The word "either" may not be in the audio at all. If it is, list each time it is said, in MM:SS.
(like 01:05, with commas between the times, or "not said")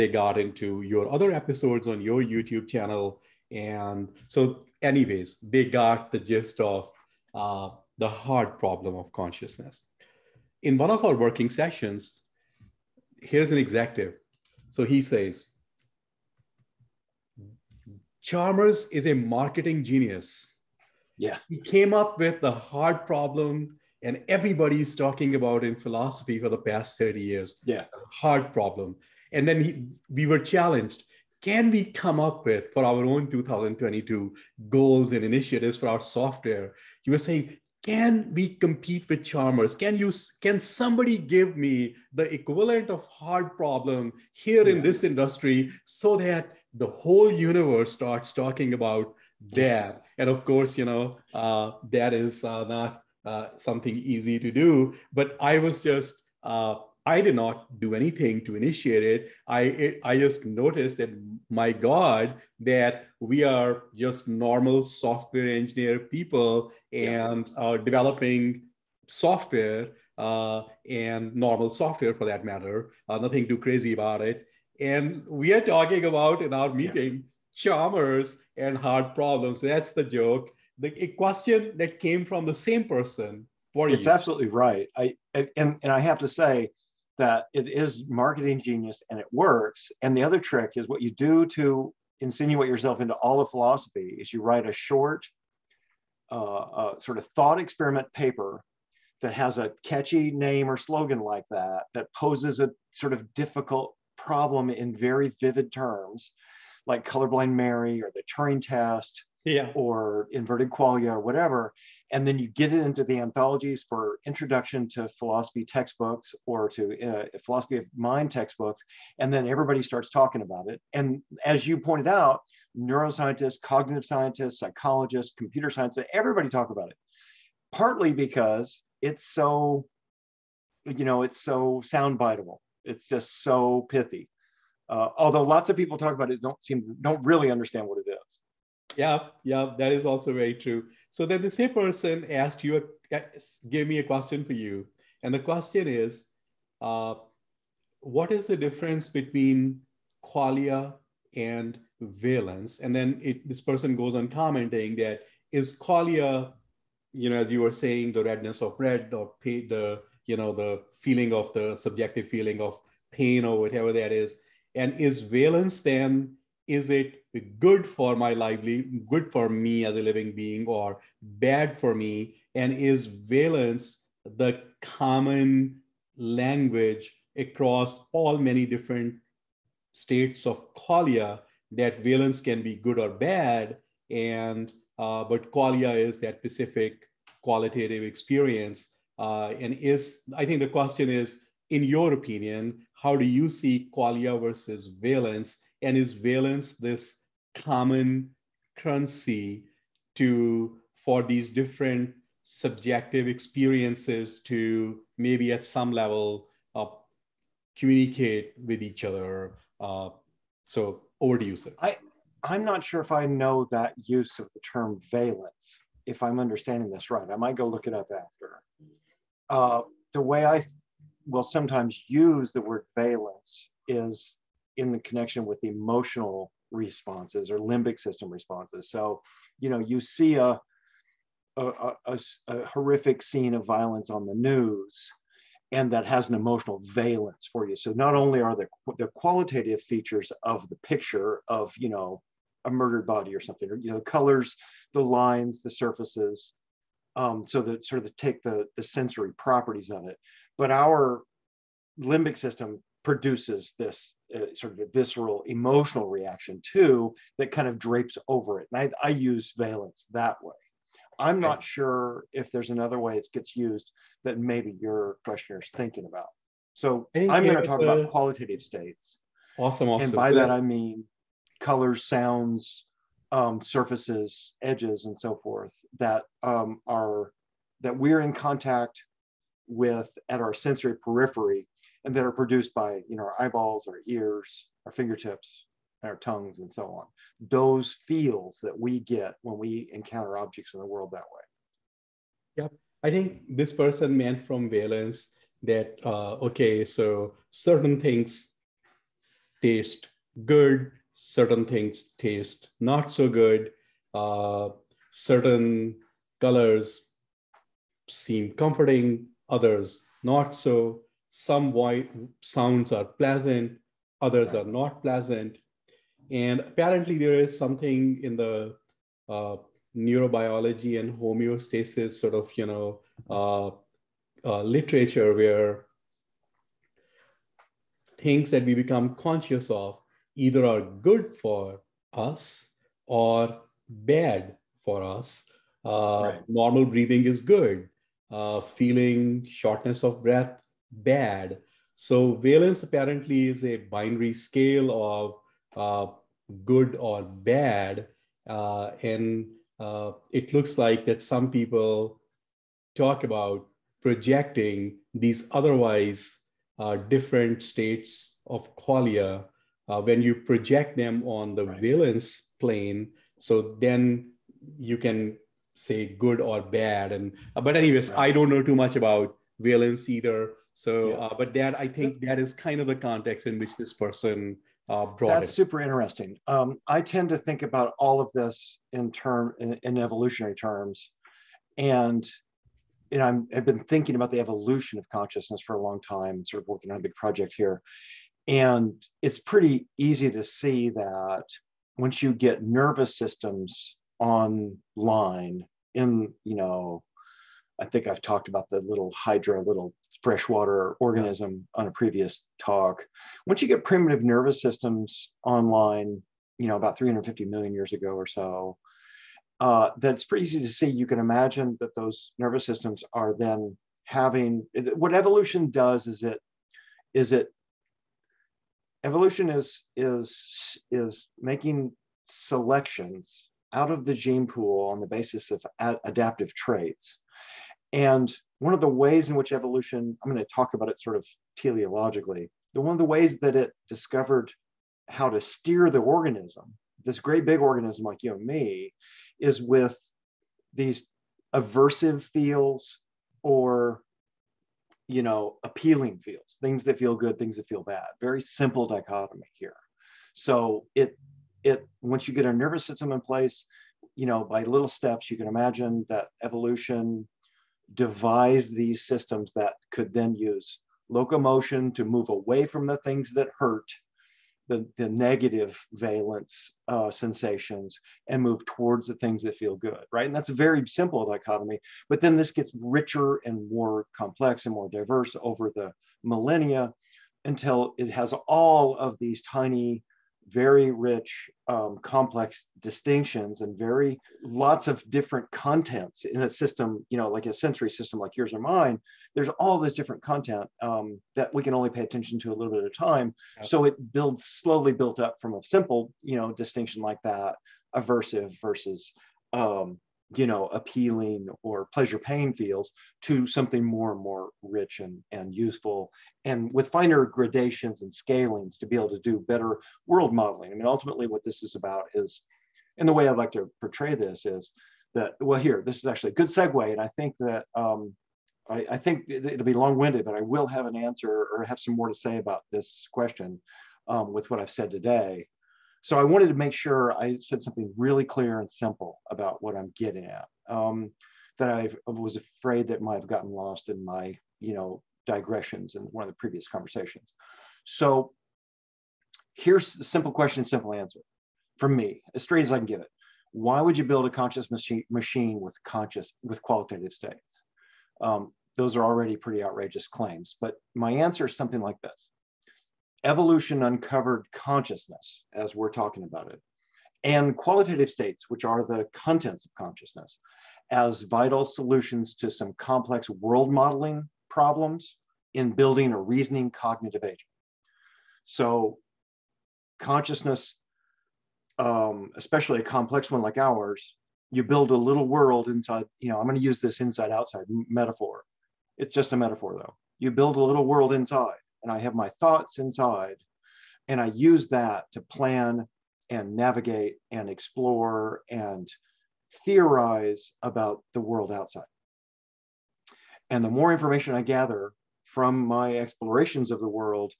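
05:30, 06:10.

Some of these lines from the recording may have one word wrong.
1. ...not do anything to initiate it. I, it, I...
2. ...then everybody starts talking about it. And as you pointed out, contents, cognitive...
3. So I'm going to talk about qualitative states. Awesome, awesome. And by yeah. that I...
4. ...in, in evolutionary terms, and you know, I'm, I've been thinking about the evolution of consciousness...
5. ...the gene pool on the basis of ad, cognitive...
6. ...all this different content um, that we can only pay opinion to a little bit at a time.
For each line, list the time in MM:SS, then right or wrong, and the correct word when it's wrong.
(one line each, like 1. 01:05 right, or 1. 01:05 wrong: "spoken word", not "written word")
1. 00:57 right
2. 01:59 wrong: "neuroscientists", not "contents"
3. 04:26 right
4. 06:19 right
5. 07:04 wrong: "adaptive", not "cognitive"
6. 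08:09 wrong: "attention", not "opinion".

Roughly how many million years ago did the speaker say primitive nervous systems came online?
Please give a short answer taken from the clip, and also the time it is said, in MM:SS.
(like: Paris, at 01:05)
350 million, at 06:46.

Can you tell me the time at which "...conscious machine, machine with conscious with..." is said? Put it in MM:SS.
09:04.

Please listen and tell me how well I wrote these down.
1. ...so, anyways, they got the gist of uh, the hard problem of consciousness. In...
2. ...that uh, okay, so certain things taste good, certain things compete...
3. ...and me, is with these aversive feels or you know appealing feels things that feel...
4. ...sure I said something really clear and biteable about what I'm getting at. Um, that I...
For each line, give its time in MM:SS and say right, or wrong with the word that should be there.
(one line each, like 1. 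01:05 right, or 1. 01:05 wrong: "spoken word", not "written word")
1. 00:04 right
2. 04:55 wrong: "taste", not "compete"
3. 07:18 right
4. 08:46 wrong: "simple", not "biteable".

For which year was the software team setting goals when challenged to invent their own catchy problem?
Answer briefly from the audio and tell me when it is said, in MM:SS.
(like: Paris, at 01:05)
2022, at 00:33.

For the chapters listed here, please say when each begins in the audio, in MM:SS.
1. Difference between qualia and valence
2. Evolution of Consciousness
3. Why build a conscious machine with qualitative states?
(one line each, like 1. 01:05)
1. 02:20
2. 06:16
3. 08:45.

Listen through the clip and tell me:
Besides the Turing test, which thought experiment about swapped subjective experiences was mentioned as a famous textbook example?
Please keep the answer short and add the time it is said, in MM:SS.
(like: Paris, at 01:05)
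inverted qualia, at 01:50.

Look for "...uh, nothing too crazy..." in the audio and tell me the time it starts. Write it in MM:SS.
01:13.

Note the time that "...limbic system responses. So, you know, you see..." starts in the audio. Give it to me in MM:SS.
03:47.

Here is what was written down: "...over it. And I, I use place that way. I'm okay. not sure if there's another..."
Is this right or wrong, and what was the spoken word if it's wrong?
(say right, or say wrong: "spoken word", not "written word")
wrong: "valence", not "place".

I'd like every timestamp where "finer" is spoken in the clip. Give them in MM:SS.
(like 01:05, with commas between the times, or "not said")
08:26.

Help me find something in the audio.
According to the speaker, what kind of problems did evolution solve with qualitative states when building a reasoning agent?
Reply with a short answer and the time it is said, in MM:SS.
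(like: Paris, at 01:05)
complex world modeling problems, at 09:22.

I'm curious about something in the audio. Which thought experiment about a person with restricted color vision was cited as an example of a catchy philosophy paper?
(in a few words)
colorblind Mary.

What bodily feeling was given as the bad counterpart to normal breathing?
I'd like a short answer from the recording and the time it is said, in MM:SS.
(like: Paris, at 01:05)
shortness of breath, at 05:39.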